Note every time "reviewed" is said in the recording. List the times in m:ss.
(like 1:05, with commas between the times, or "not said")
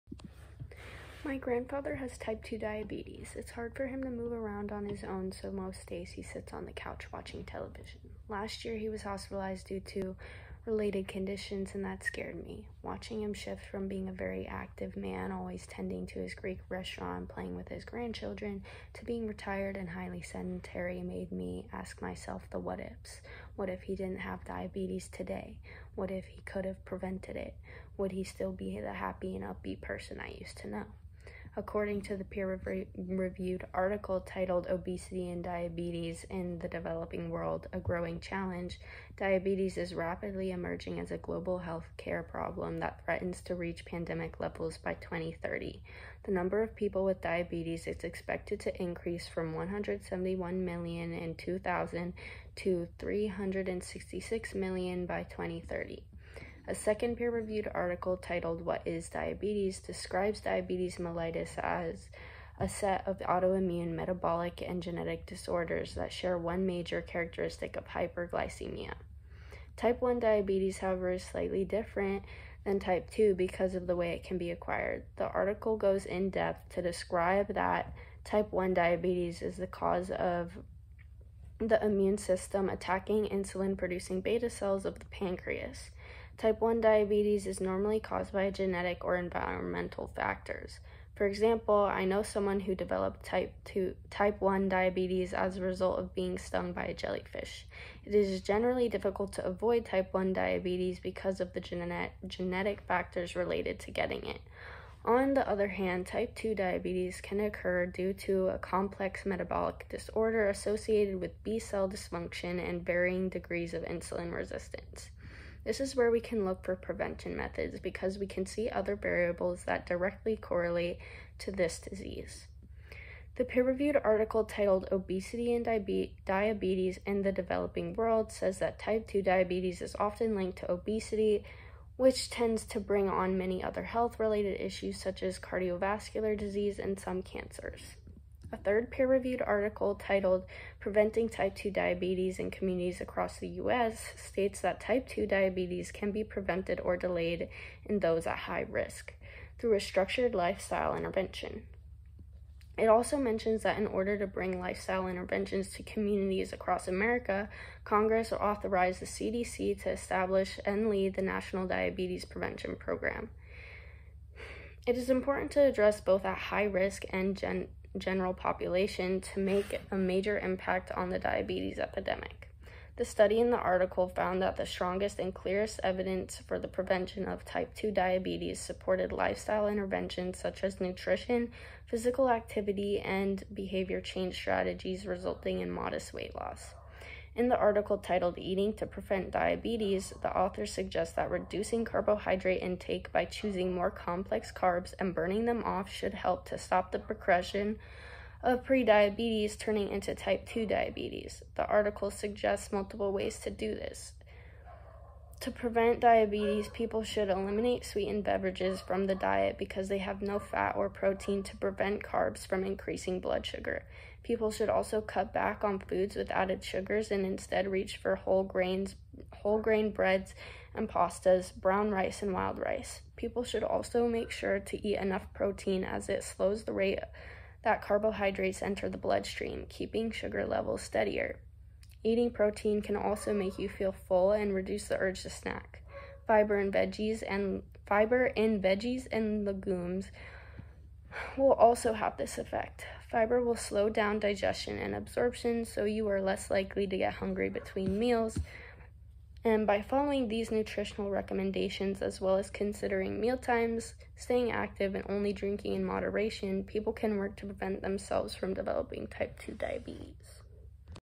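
0:32, 0:57, 2:03, 2:18.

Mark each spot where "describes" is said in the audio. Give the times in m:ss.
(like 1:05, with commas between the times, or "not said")
0:59, 1:16.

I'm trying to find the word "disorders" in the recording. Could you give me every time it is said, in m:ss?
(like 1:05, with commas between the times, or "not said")
1:05, 1:49.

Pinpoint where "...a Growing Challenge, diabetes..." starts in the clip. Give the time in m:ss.
0:37.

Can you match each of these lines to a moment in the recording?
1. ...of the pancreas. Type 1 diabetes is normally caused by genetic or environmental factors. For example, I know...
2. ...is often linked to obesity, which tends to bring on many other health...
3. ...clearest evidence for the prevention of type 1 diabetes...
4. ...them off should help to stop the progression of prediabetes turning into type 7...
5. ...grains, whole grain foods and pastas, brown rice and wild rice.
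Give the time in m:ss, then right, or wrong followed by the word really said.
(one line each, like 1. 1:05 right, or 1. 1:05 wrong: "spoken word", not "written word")
1. 1:24 right
2. 2:09 right
3. 2:55 wrong: "2", not "1"
4. 3:15 wrong: "2", not "7"
5. 3:38 wrong: "breads", not "foods".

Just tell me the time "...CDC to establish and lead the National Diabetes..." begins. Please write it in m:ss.
2:39.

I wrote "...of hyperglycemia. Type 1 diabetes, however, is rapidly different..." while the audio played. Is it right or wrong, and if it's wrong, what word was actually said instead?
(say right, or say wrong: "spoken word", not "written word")
wrong: "slightly", not "rapidly".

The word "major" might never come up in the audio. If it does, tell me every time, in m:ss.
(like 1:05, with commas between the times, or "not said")
1:06, 2:49.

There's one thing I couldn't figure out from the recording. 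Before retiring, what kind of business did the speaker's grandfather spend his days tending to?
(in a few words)
Greek restaurant.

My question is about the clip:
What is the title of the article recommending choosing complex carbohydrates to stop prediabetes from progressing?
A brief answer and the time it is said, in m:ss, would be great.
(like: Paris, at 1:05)
Eating to Prevent Diabetes, at 3:08.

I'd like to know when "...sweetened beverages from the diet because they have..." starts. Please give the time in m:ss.
3:27.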